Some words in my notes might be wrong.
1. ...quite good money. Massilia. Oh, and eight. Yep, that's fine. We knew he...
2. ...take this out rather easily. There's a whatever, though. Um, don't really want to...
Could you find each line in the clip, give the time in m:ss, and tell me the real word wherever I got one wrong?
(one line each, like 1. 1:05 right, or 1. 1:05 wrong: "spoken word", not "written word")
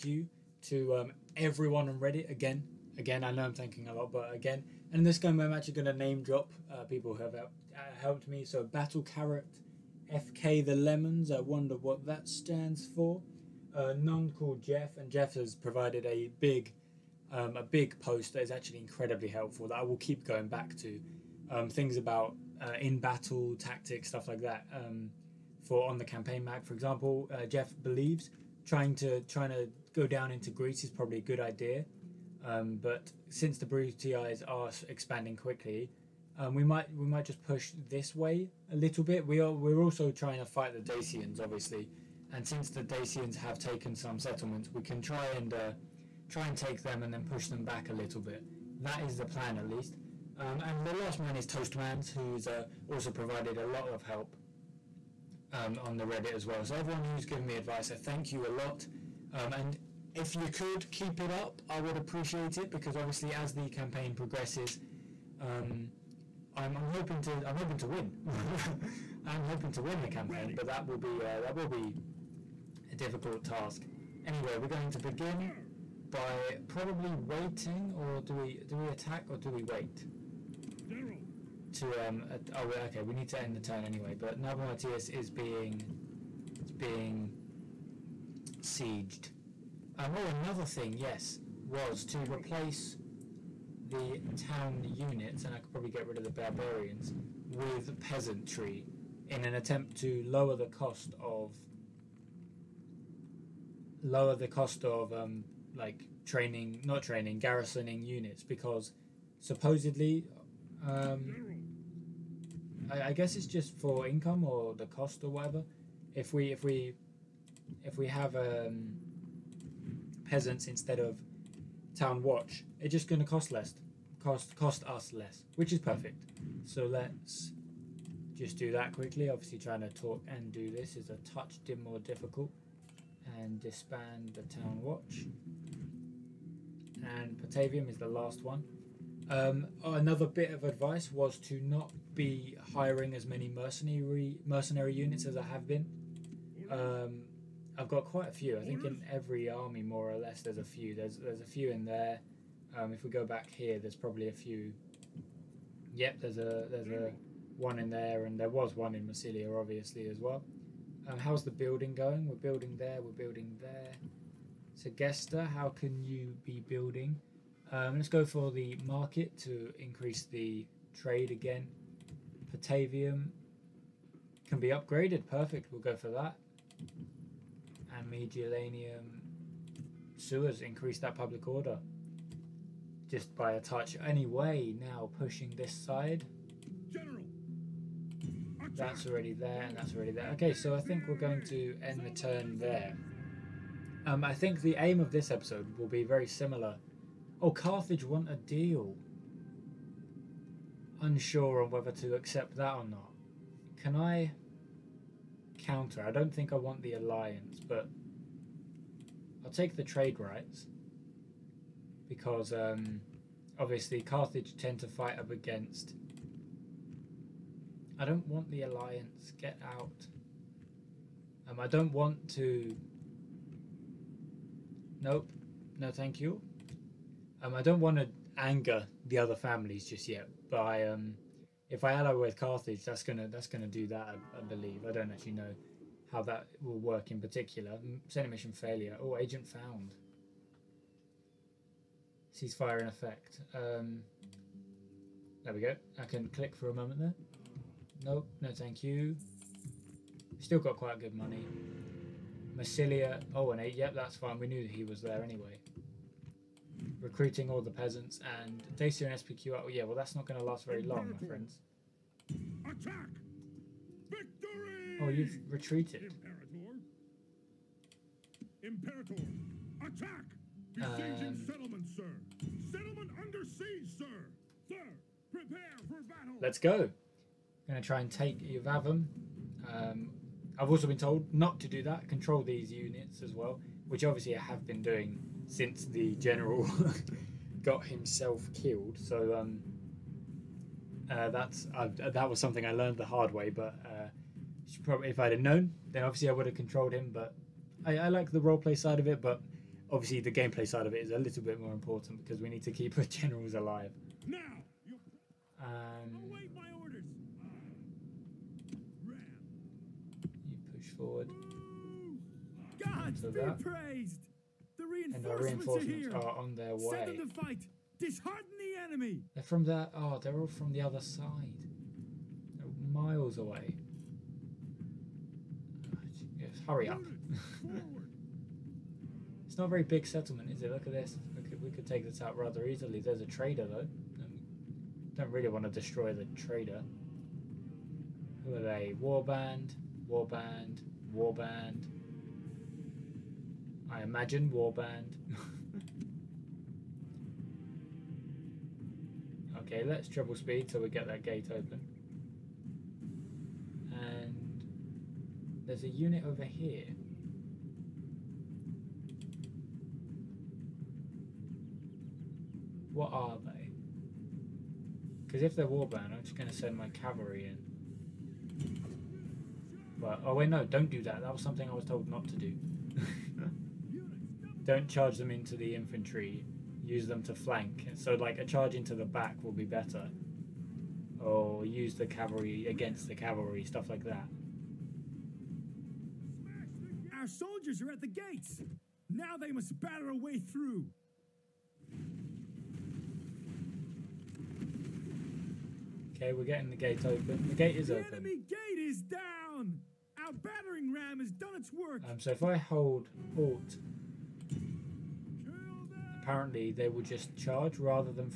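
1. 4:10 right
2. 5:31 wrong: "trader", not "whatever".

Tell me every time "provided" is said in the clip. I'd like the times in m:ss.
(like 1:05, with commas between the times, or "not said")
0:15, 0:53.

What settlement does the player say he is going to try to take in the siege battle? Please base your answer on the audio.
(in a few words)
Iuvavum.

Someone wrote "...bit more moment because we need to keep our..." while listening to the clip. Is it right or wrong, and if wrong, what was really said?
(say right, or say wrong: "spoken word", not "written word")
wrong: "important", not "moment".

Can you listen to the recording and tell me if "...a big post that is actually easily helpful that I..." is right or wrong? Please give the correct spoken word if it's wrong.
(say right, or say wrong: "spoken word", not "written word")
wrong: "incredibly", not "easily".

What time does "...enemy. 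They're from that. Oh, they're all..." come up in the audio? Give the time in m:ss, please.
5:18.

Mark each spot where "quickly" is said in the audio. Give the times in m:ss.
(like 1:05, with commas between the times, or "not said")
0:35, 2:08.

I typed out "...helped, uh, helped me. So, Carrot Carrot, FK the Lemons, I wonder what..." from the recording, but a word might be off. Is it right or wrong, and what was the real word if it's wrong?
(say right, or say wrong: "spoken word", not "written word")
wrong: "Battle", not "Carrot".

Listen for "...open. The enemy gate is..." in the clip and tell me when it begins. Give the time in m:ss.
6:37.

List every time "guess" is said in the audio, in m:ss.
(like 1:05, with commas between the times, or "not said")
1:53.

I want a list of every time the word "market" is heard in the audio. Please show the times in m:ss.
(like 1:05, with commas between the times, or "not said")
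2:48.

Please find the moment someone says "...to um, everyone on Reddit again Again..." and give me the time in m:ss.
0:00.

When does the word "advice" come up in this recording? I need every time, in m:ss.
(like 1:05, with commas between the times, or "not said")
0:57, 2:20.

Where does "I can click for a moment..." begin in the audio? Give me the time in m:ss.
4:06.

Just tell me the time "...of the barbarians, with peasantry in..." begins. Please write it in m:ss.
1:36.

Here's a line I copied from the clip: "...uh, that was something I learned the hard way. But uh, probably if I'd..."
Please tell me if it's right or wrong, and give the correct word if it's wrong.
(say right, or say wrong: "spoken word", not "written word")
right.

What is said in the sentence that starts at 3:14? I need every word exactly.
Um, I think the aim of this episode will be very similar.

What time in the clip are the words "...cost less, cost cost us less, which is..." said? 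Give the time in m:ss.
2:03.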